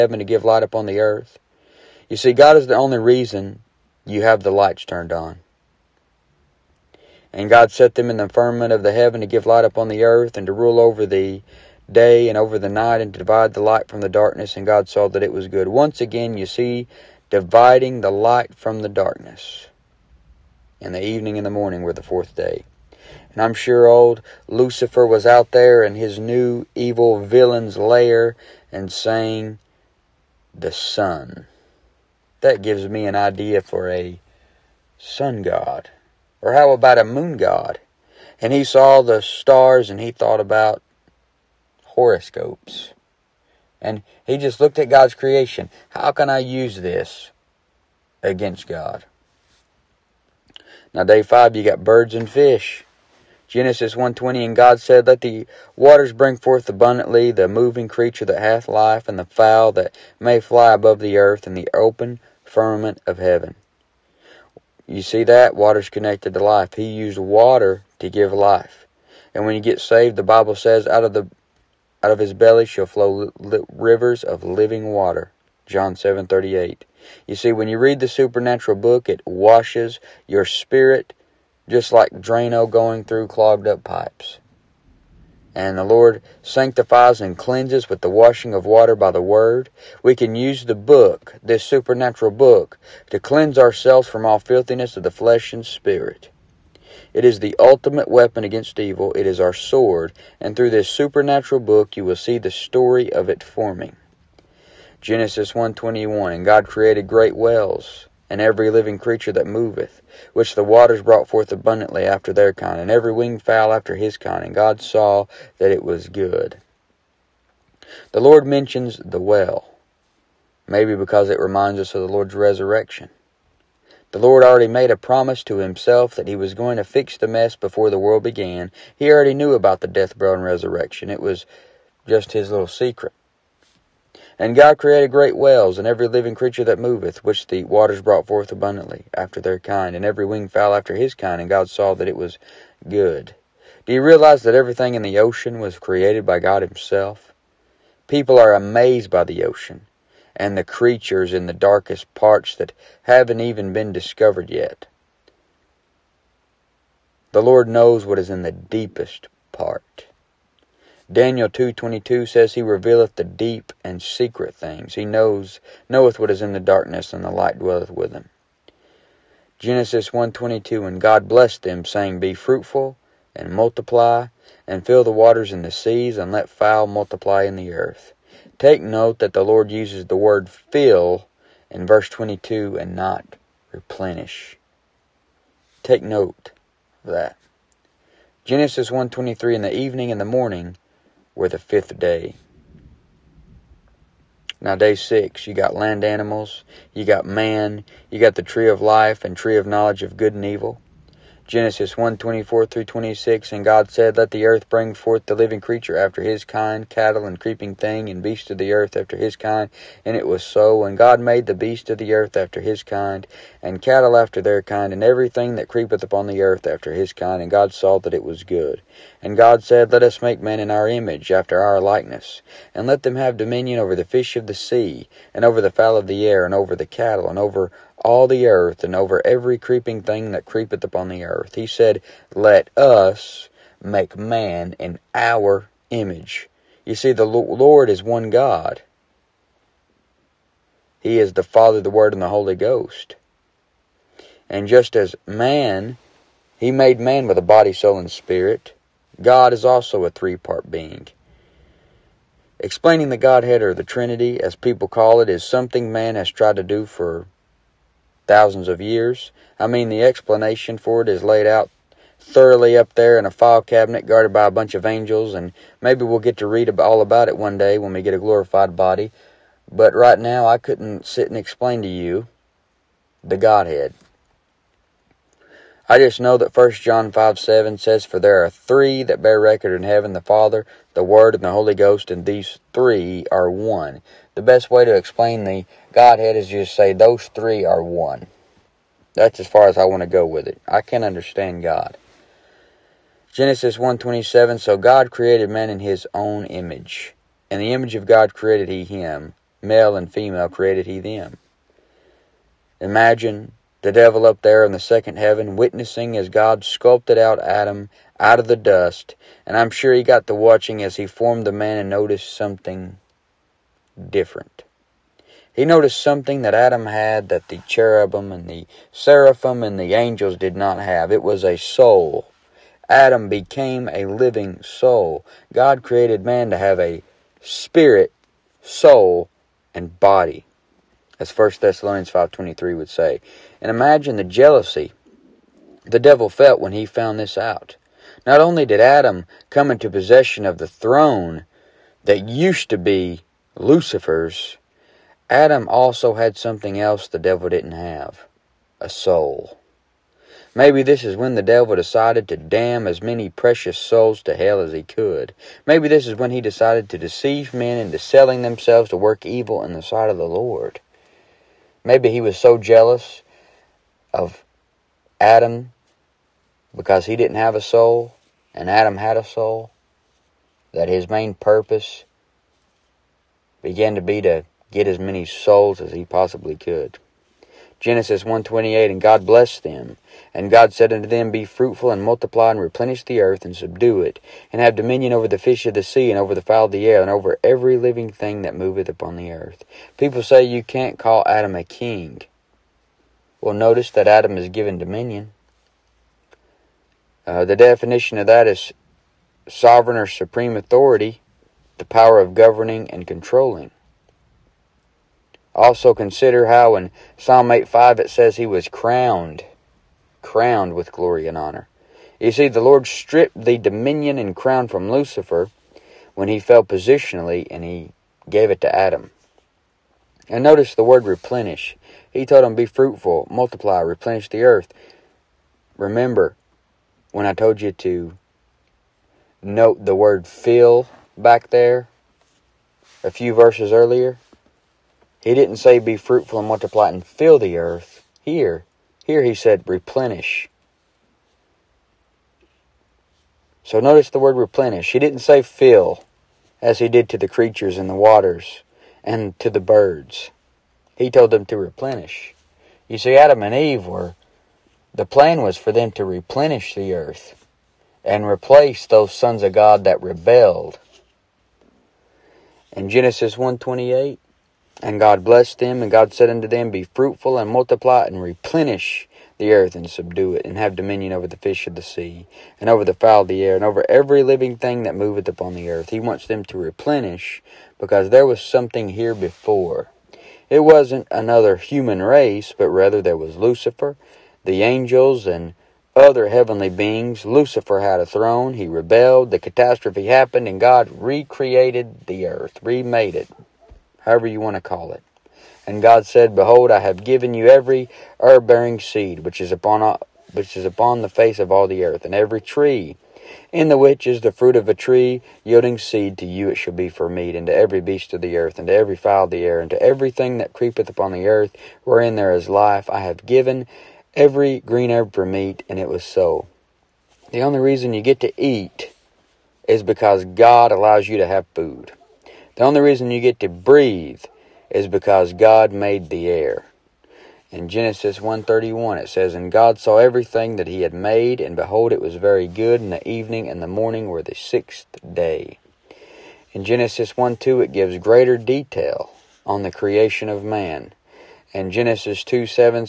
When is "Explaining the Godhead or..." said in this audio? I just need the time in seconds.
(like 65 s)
252 s.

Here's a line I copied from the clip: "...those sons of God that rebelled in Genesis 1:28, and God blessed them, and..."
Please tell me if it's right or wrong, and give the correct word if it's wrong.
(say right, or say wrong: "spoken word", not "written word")
right.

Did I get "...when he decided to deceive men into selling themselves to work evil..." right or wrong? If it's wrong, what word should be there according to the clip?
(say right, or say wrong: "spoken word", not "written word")
right.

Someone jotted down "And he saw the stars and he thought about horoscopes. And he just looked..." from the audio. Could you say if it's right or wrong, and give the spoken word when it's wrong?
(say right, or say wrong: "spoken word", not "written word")
right.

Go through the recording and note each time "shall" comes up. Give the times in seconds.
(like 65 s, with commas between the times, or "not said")
72 s, 506 s.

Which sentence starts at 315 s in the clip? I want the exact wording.
He noticed something that Adam had that the cherubim and the seraphim and the angels did not have.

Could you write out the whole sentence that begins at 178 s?
Take note that the Lord uses the word fill in verse 22 and not replenish.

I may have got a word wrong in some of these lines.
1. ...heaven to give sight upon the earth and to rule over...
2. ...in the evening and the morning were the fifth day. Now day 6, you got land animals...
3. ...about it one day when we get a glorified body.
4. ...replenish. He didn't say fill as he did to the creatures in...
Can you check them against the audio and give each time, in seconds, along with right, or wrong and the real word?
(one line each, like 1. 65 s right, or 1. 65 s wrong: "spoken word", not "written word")
1. 8 s wrong: "light", not "sight"
2. 189 s right
3. 267 s right
4. 444 s right.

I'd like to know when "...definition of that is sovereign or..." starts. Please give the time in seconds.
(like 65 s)
397 s.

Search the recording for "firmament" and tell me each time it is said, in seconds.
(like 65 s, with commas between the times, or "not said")
8 s, 62 s.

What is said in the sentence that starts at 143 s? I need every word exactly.
Do you realize that everything in the ocean was created by God himself?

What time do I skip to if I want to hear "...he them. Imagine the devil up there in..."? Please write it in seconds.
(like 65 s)
300 s.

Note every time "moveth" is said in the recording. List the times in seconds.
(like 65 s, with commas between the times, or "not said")
109 s, 136 s, 388 s, 474 s.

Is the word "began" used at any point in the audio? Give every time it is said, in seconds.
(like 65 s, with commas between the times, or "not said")
128 s, 373 s.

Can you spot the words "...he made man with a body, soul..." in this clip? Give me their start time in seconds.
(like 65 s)
246 s.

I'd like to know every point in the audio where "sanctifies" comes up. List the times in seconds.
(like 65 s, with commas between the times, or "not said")
86 s.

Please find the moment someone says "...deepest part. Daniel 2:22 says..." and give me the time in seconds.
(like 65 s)
158 s.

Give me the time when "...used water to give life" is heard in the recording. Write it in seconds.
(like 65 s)
66 s.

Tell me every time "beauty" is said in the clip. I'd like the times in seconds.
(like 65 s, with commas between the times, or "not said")
not said.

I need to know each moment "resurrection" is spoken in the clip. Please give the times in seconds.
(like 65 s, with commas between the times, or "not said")
122 s, 130 s.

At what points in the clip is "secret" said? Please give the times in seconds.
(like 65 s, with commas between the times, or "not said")
132 s, 164 s.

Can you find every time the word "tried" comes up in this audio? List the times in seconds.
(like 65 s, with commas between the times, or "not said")
256 s.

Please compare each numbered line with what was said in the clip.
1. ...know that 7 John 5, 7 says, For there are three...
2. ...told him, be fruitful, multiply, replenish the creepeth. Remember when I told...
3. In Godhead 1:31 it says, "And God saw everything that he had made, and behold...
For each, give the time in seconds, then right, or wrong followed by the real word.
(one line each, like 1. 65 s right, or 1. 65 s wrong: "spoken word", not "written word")
1. 276 s wrong: "1", not "7"
2. 422 s wrong: "earth", not "creepeth"
3. 527 s wrong: "Genesis", not "Godhead".